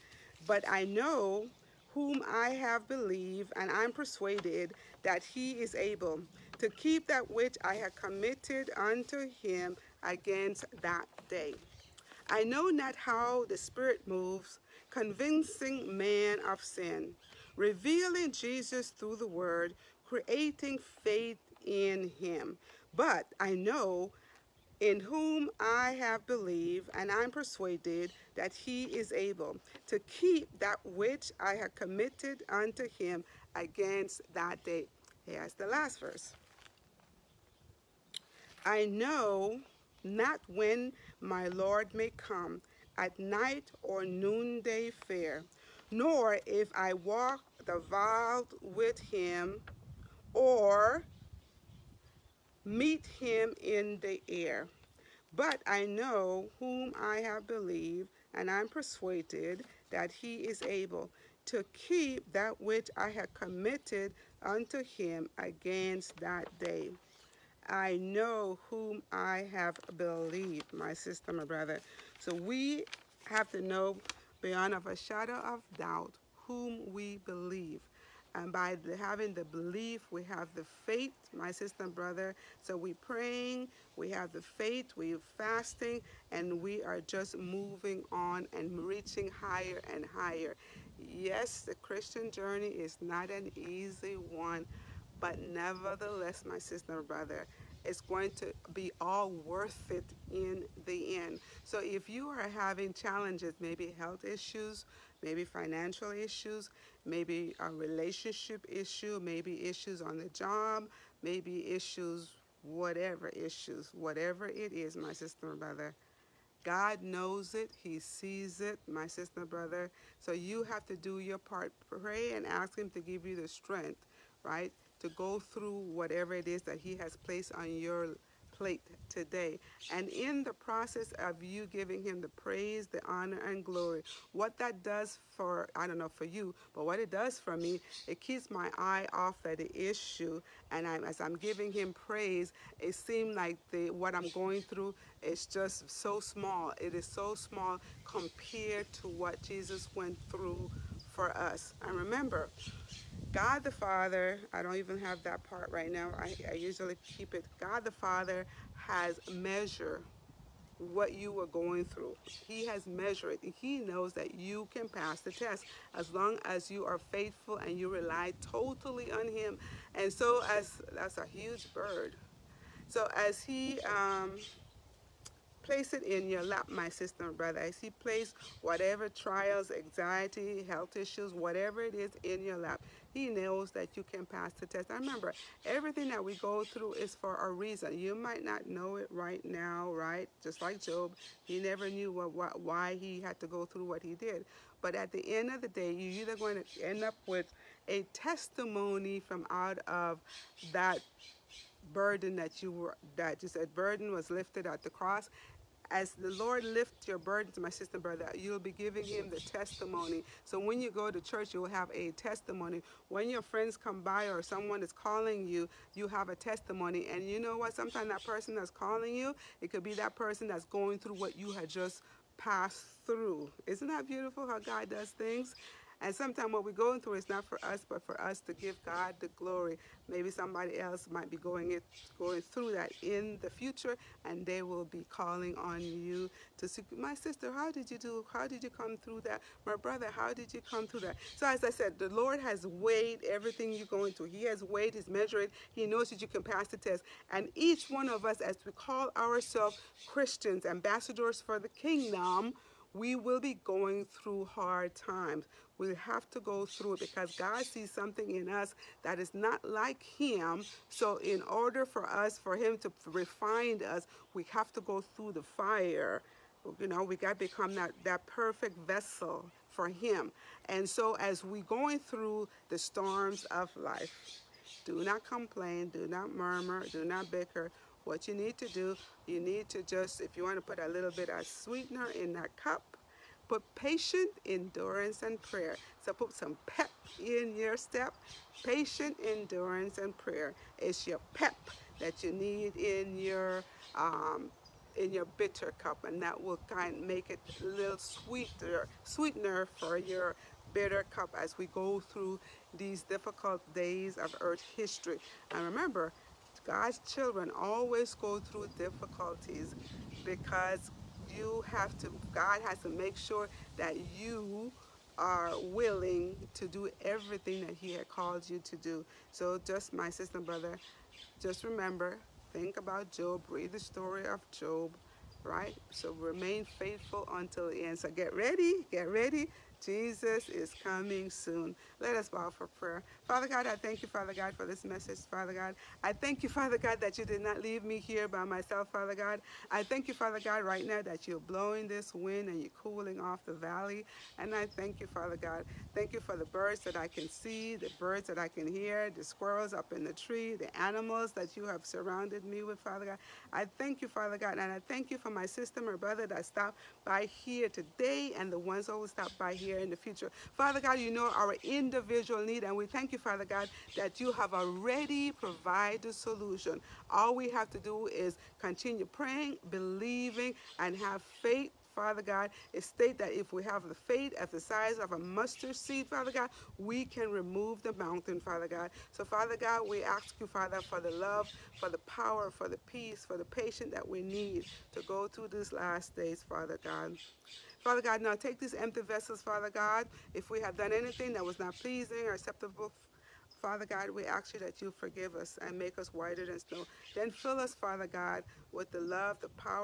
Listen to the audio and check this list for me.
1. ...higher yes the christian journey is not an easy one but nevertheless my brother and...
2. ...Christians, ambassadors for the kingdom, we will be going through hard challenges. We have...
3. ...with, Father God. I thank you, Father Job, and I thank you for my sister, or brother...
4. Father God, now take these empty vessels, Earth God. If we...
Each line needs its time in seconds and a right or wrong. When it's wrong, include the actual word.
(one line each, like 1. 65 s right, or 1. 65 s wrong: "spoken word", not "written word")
1. 90 s wrong: "sister", not "brother"
2. 250 s wrong: "times", not "challenges"
3. 352 s wrong: "God", not "Job"
4. 387 s wrong: "Father", not "Earth".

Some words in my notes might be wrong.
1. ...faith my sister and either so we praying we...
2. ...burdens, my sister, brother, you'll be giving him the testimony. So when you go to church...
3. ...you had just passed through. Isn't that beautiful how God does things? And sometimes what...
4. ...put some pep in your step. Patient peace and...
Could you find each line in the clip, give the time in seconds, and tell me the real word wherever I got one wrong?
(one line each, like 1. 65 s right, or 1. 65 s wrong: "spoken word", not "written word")
1. 80 s wrong: "brother", not "either"
2. 207 s right
3. 221 s right
4. 286 s wrong: "endurance", not "peace".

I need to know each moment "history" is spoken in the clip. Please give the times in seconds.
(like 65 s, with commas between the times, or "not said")
304 s.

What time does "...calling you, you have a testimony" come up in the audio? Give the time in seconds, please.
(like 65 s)
214 s.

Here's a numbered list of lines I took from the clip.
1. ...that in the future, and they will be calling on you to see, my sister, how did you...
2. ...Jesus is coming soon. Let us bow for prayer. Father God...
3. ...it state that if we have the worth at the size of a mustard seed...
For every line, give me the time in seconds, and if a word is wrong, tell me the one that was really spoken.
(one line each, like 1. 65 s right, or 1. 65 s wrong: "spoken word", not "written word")
1. 232 s right
2. 329 s right
3. 372 s wrong: "faith", not "worth".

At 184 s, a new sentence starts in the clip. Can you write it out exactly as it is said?
I remember everything that we go through is for a reason.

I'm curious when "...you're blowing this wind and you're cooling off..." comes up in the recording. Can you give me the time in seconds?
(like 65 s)
341 s.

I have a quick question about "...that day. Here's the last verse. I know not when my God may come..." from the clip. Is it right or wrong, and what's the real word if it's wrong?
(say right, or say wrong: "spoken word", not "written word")
wrong: "Lord", not "God".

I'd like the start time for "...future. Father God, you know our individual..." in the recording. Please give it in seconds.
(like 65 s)
359 s.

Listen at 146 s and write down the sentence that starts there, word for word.
It is so small compared to what Jesus went through for us.